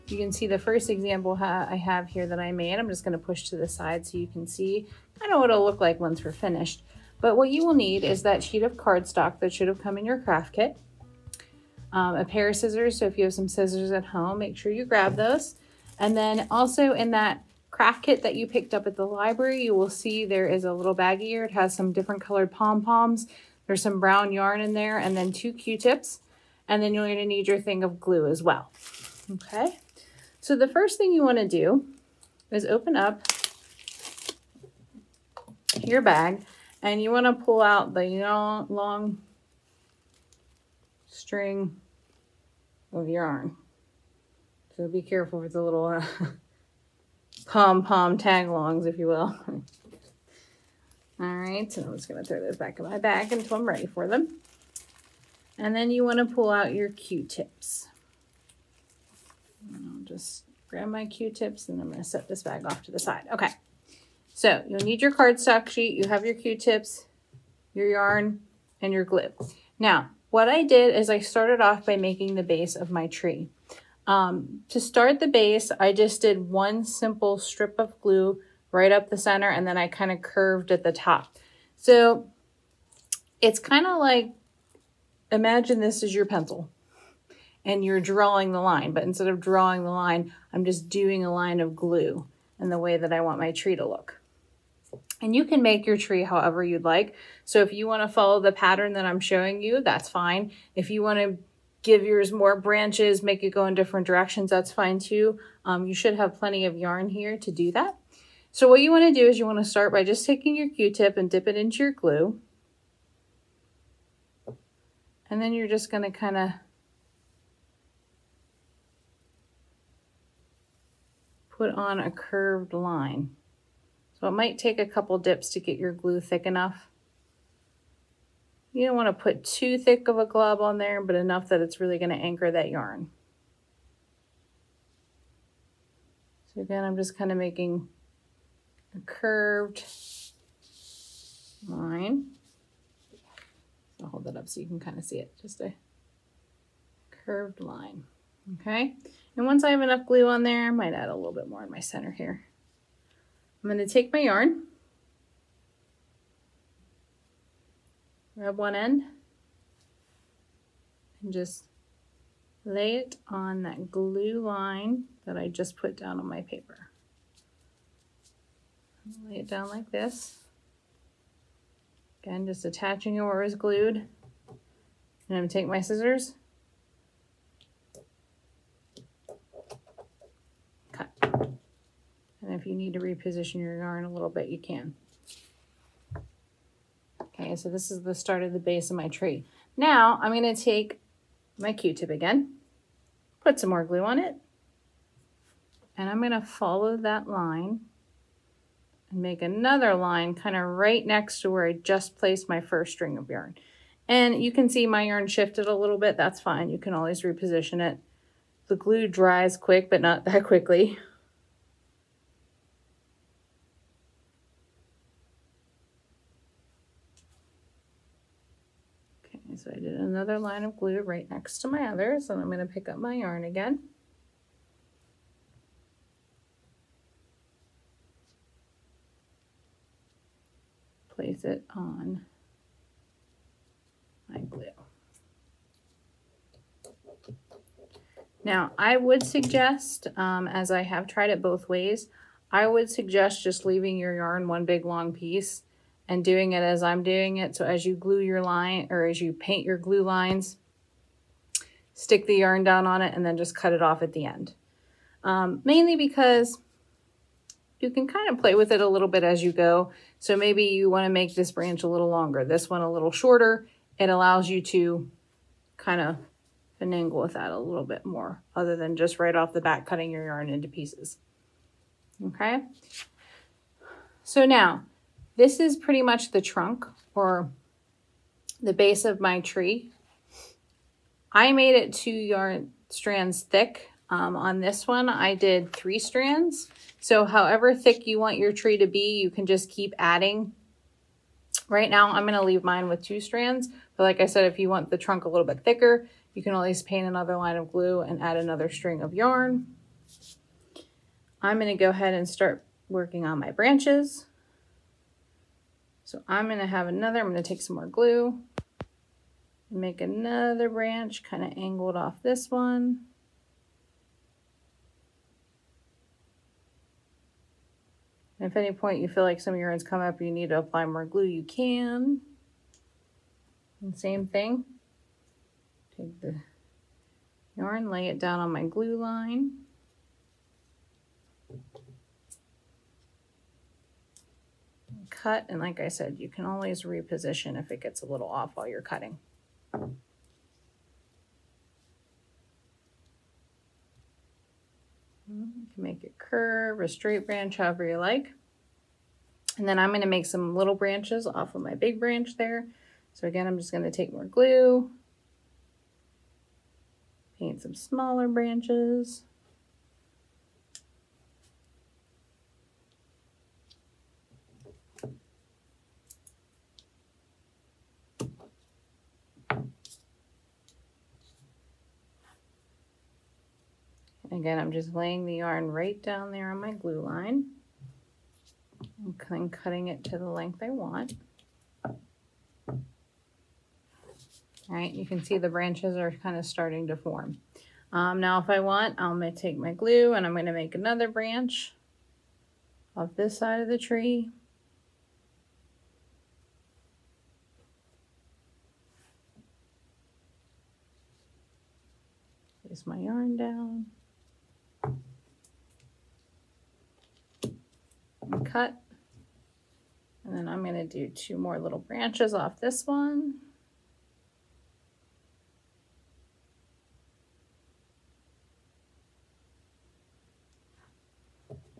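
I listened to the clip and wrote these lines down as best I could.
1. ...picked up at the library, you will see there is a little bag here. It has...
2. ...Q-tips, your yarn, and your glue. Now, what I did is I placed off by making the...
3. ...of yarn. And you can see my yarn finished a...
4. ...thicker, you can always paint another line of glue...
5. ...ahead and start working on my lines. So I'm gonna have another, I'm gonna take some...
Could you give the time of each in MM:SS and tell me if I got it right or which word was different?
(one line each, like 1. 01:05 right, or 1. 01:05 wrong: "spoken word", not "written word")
1. 00:18 right
2. 01:06 wrong: "started", not "placed"
3. 03:23 wrong: "shifted", not "finished"
4. 04:55 right
5. 05:01 wrong: "branches", not "lines".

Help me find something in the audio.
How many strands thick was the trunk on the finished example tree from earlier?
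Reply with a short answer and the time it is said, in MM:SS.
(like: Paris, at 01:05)
3, at 04:45.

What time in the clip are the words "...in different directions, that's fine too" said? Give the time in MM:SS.
01:43.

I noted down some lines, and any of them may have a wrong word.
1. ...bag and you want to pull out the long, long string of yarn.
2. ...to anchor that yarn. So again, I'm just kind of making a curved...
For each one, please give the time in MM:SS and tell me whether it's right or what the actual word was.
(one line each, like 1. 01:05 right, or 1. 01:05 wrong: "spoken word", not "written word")
1. 00:36 right
2. 02:12 right.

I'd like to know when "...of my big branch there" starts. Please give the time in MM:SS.
05:51.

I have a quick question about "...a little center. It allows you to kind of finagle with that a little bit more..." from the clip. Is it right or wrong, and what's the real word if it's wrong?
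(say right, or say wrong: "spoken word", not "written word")
wrong: "shorter", not "center".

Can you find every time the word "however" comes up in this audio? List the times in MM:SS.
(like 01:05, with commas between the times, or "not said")
01:36, 04:47, 05:47.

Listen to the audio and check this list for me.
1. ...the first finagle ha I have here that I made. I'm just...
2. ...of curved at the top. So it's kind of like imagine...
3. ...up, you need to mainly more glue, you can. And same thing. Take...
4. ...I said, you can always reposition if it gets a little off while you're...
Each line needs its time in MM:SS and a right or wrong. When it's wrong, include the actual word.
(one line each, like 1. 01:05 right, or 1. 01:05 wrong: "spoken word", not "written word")
1. 00:00 wrong: "example", not "finagle"
2. 01:20 right
3. 05:20 wrong: "apply", not "mainly"
4. 05:35 right.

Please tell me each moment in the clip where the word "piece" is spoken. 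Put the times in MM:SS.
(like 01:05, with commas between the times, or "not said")
04:05, 04:30.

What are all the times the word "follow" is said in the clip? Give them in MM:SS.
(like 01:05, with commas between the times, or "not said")
01:38, 03:16.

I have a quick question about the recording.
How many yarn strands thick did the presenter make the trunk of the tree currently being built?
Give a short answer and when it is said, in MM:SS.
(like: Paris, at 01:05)
2, at 04:41.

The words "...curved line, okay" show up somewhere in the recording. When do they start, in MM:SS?
02:27.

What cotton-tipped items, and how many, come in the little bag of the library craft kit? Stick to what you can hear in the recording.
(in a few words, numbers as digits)
2 Q-tips.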